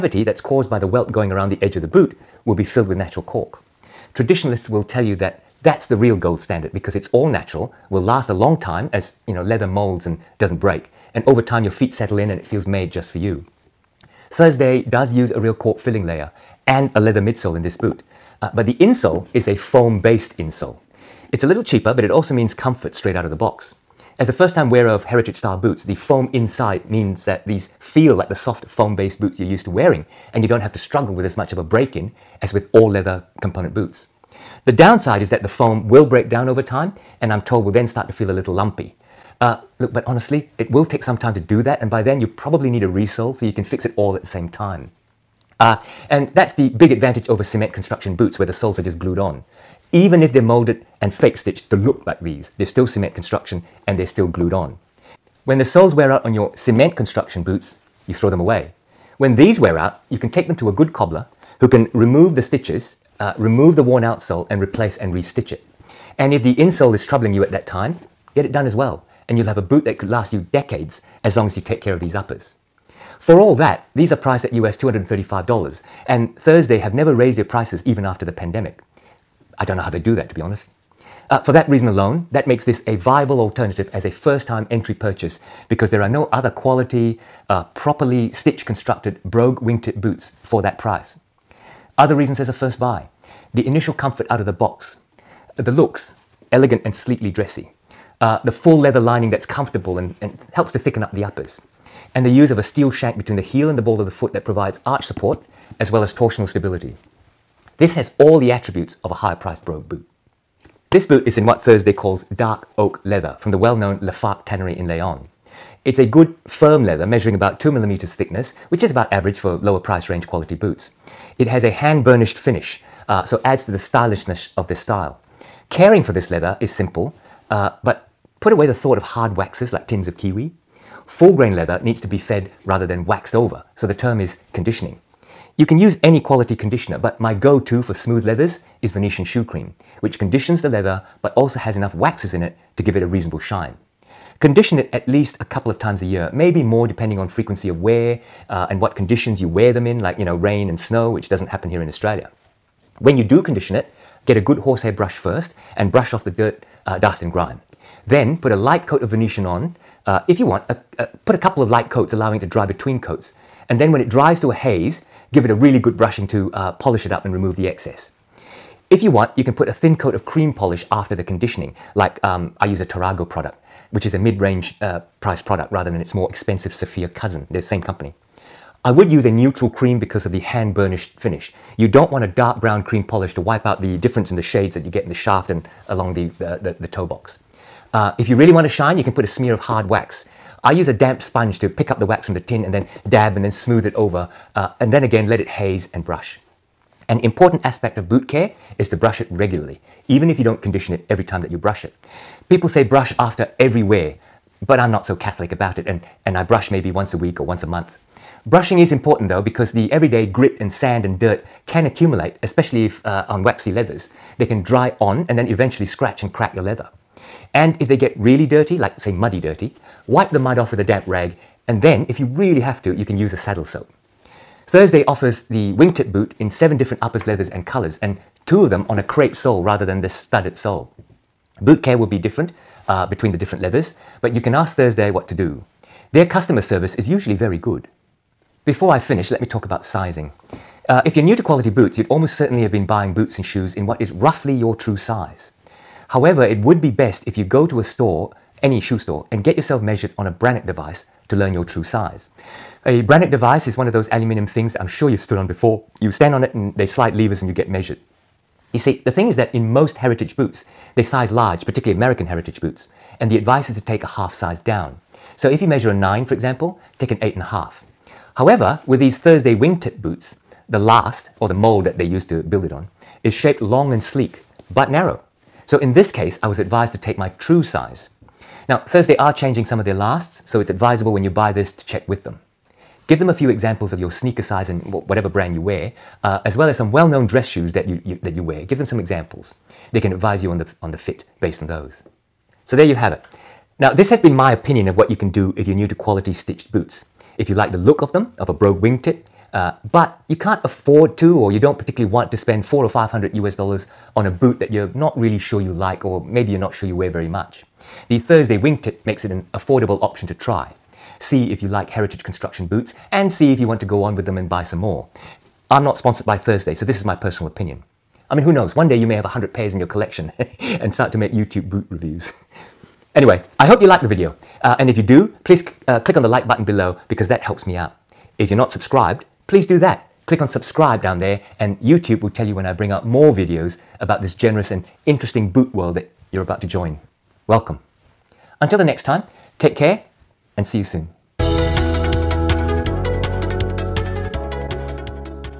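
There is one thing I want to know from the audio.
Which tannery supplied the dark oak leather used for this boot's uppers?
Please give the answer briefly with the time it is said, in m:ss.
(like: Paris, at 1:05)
Lafargue, at 1:54.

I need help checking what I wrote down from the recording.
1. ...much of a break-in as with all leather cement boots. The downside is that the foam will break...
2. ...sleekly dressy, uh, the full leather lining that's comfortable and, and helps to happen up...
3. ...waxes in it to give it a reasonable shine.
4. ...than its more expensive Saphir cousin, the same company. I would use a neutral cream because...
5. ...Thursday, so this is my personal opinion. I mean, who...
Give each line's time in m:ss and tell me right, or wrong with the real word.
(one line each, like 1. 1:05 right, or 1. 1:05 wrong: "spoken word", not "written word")
1. 0:31 wrong: "component", not "cement"
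2. 1:36 wrong: "thicken", not "happen"
3. 2:21 right
4. 2:55 right
5. 5:16 right.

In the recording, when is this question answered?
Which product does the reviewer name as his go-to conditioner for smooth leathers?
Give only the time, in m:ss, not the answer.
2:18.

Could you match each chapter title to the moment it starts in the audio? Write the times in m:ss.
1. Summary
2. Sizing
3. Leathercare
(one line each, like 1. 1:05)
1. 4:52
2. 3:57
3. 1:49.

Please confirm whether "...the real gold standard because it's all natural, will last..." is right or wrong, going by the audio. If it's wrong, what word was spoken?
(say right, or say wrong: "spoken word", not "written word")
right.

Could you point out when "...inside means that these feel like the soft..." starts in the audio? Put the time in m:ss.
0:26.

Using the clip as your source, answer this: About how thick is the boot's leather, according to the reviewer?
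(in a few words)
2 millimeters.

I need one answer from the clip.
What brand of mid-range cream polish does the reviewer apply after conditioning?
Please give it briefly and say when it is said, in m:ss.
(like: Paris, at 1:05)
Tarrago, at 2:52.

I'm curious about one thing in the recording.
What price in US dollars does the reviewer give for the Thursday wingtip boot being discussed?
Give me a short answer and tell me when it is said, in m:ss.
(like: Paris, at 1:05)
$235, at 1:14.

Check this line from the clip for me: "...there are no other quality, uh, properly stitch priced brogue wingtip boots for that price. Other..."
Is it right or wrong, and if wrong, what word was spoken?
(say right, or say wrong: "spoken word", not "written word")
wrong: "constructed", not "priced".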